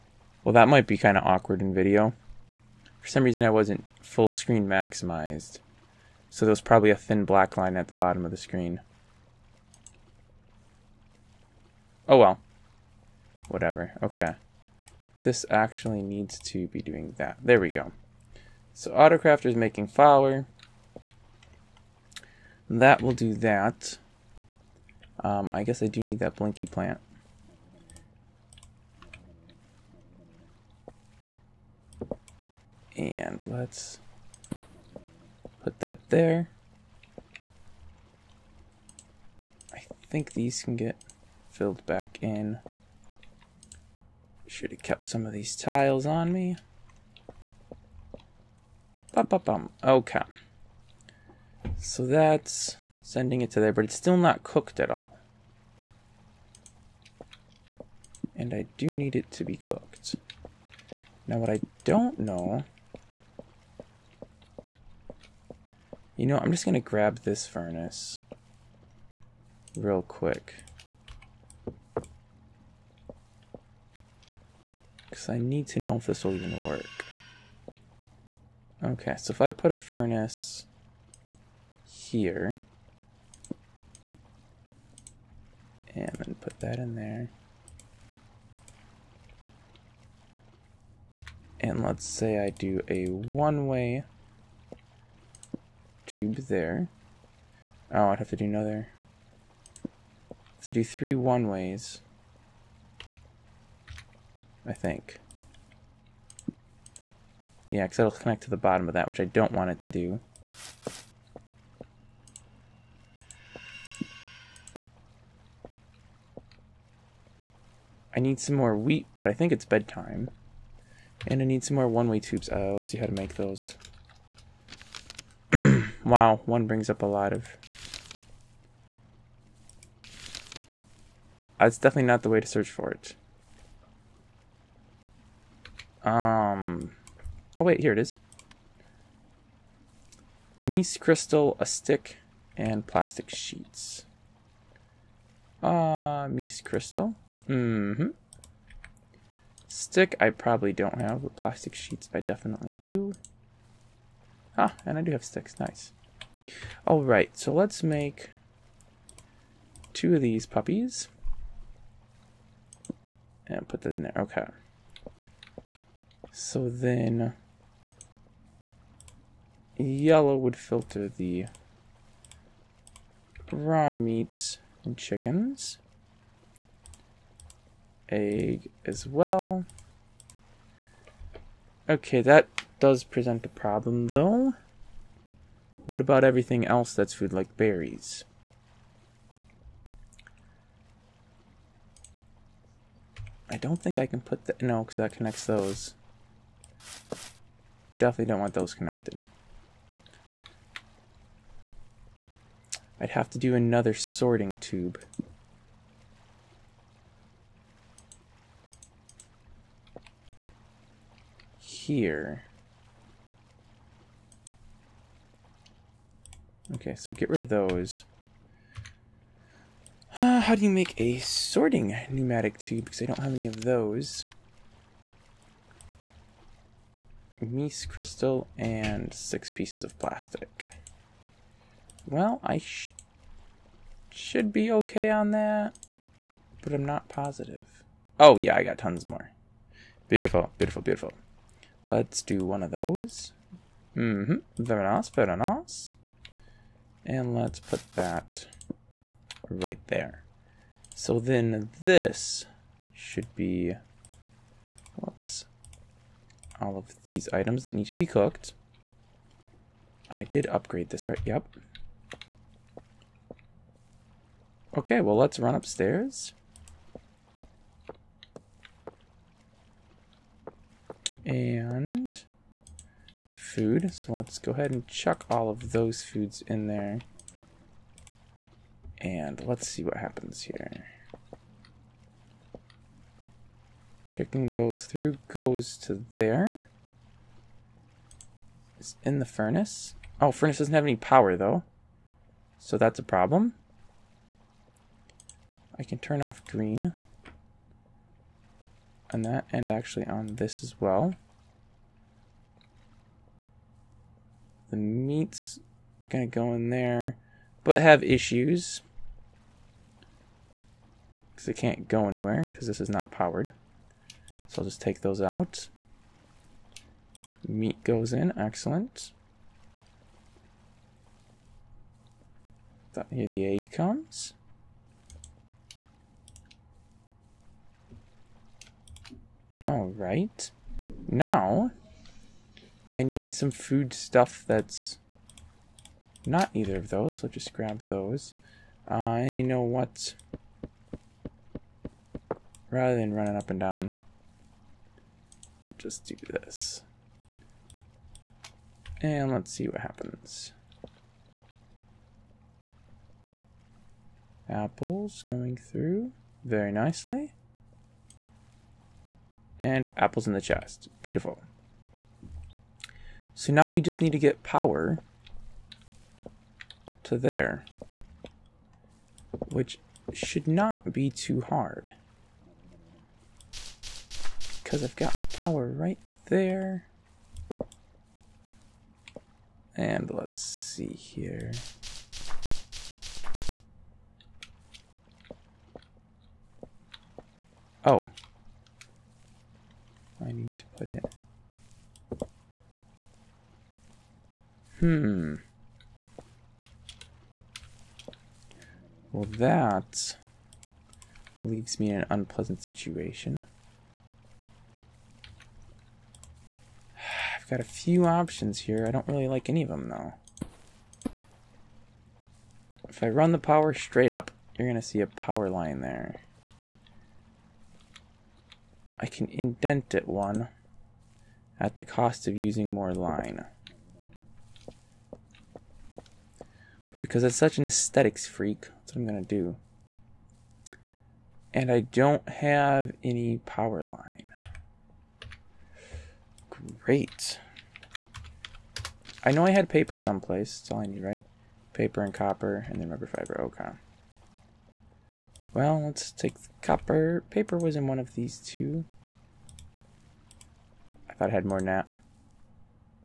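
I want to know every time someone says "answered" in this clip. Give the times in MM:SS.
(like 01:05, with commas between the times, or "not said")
not said.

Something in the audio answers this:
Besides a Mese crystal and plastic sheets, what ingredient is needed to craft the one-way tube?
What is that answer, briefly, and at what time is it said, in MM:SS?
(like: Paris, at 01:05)
a stick, at 02:21.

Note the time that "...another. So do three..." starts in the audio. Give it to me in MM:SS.
01:38.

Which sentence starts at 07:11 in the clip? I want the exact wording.
And I don't have any power line.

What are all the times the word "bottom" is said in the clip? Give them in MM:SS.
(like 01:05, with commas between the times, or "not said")
00:07, 01:48.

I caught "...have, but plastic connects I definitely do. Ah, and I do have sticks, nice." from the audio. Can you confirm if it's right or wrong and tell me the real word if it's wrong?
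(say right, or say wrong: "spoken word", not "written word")
wrong: "sheets", not "connects".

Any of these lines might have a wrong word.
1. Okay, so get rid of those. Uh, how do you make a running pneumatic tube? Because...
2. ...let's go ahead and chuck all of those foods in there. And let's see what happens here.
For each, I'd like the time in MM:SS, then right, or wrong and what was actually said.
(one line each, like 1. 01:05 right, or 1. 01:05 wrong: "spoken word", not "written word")
1. 03:36 wrong: "sorting", not "running"
2. 04:34 right.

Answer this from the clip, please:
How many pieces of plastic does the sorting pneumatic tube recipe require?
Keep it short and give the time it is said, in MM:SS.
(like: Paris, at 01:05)
6, at 03:49.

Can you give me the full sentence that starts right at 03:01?
Okay, that does present a problem, though.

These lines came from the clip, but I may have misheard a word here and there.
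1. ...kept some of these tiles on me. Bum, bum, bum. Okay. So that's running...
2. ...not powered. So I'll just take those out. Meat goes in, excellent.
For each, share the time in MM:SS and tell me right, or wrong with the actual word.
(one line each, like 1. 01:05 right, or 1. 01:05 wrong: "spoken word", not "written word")
1. 00:44 wrong: "sending", not "running"
2. 05:12 right.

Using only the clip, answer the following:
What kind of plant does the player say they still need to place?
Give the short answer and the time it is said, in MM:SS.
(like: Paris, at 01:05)
blinky plant, at 00:26.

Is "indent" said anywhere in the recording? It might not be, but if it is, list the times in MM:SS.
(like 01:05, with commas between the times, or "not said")
06:59.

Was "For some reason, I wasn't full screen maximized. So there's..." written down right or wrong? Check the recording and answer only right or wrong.
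right.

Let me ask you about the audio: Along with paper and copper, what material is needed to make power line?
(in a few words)
rubber fiber.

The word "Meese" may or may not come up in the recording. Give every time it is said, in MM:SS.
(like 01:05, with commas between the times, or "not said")
02:20, 02:26.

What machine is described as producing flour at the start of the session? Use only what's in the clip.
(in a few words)
Autocrafter.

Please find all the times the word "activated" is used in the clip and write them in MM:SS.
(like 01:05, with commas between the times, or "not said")
not said.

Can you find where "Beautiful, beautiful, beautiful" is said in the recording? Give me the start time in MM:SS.
04:00.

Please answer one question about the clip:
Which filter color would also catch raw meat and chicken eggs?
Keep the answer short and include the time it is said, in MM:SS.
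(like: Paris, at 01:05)
yellow, at 02:49.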